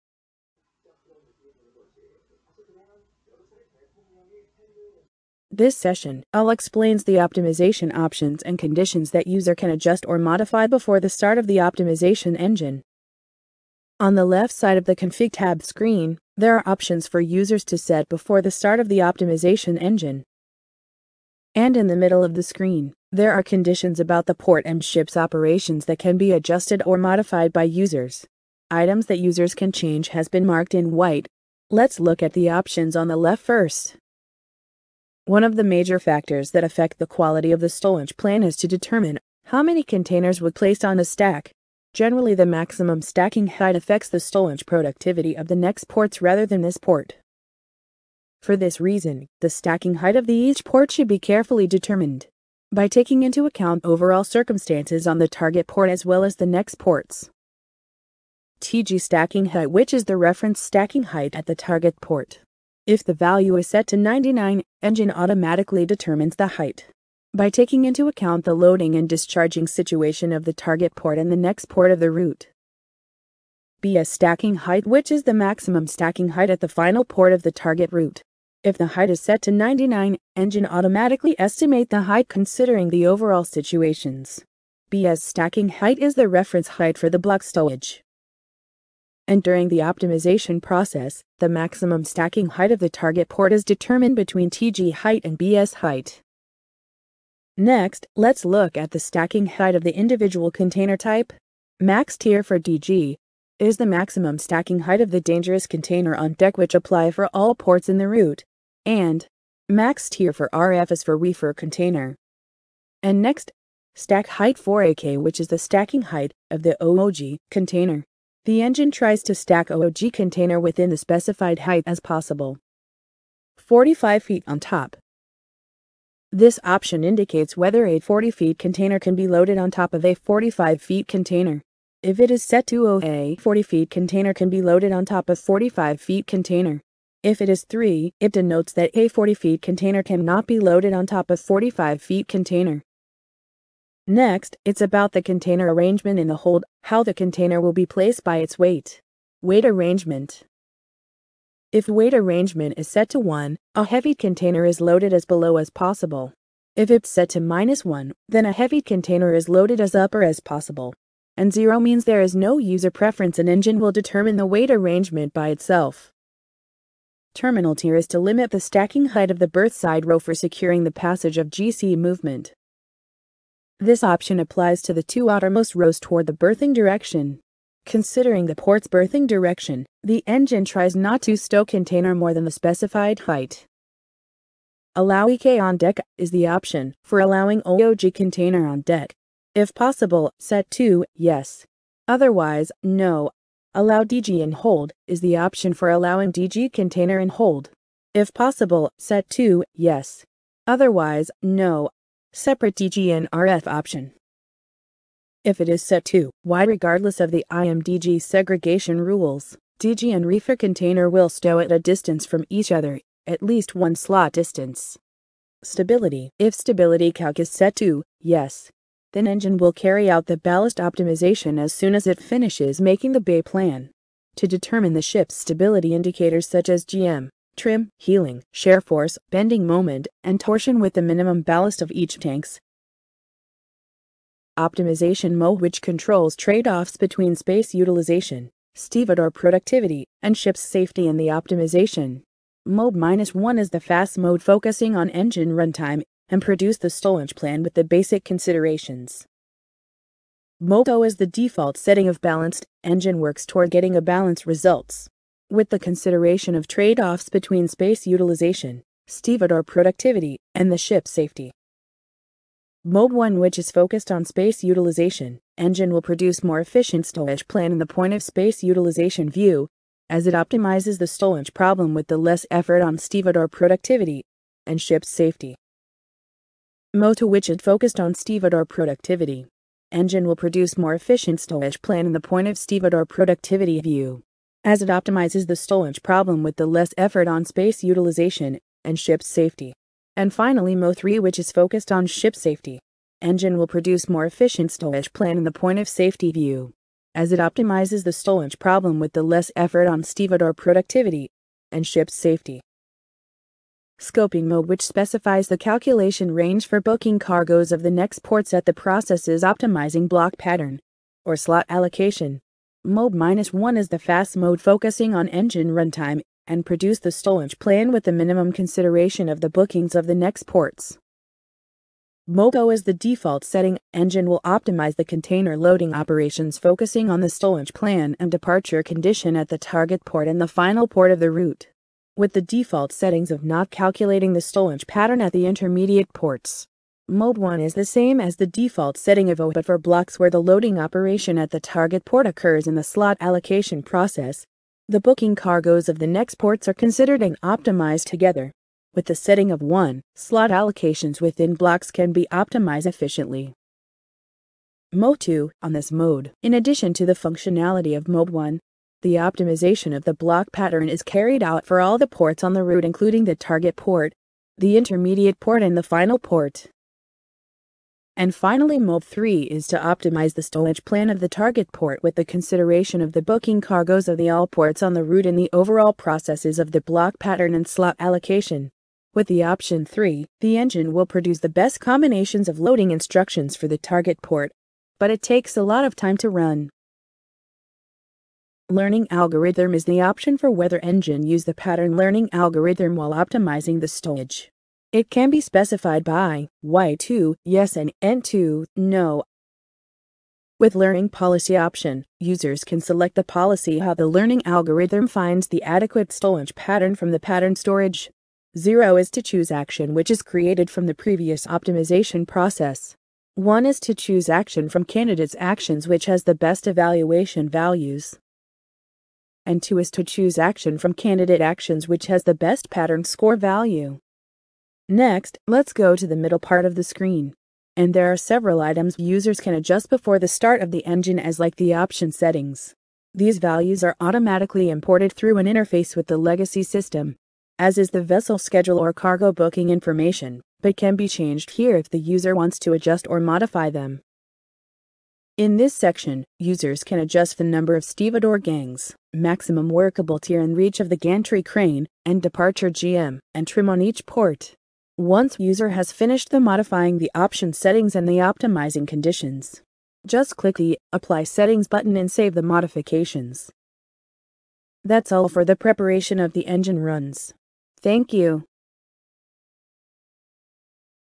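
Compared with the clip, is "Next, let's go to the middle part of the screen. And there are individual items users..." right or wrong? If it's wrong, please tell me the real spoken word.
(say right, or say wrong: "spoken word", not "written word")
wrong: "several", not "individual".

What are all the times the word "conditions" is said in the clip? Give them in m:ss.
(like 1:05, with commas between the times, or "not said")
0:08, 0:23, 5:28, 7:38.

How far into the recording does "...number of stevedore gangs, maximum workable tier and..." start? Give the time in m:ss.
7:27.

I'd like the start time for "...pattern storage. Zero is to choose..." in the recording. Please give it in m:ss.
6:47.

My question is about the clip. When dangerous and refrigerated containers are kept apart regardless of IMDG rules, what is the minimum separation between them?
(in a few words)
One slot distance.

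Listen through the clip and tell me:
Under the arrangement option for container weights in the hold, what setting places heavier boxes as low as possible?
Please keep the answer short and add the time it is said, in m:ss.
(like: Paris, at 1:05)
1, at 2:31.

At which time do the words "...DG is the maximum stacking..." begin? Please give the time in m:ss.
1:42.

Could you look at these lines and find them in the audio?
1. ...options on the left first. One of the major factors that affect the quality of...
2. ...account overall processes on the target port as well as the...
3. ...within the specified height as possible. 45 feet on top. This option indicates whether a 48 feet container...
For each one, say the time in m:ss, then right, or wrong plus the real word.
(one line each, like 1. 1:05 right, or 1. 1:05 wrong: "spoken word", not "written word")
1. 0:32 right
2. 0:53 wrong: "circumstances", not "processes"
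3. 2:00 wrong: "40", not "48".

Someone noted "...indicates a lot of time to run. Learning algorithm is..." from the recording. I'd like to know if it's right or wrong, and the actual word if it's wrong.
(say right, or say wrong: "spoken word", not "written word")
wrong: "takes", not "indicates".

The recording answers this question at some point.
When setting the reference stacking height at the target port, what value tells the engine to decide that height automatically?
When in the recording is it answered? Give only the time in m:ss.
1:02.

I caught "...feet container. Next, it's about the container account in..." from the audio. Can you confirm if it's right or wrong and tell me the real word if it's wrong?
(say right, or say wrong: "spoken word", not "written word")
wrong: "arrangement", not "account".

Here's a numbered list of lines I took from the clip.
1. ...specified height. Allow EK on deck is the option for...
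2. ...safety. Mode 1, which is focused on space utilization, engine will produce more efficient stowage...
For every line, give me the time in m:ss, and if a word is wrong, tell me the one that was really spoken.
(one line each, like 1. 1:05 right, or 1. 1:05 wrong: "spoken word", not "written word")
1. 3:02 right
2. 4:21 right.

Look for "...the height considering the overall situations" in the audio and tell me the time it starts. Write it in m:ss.
1:21.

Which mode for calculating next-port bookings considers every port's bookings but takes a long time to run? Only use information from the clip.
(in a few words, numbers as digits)
3.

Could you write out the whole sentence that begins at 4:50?
And finally MO3 which is focused on ship safety.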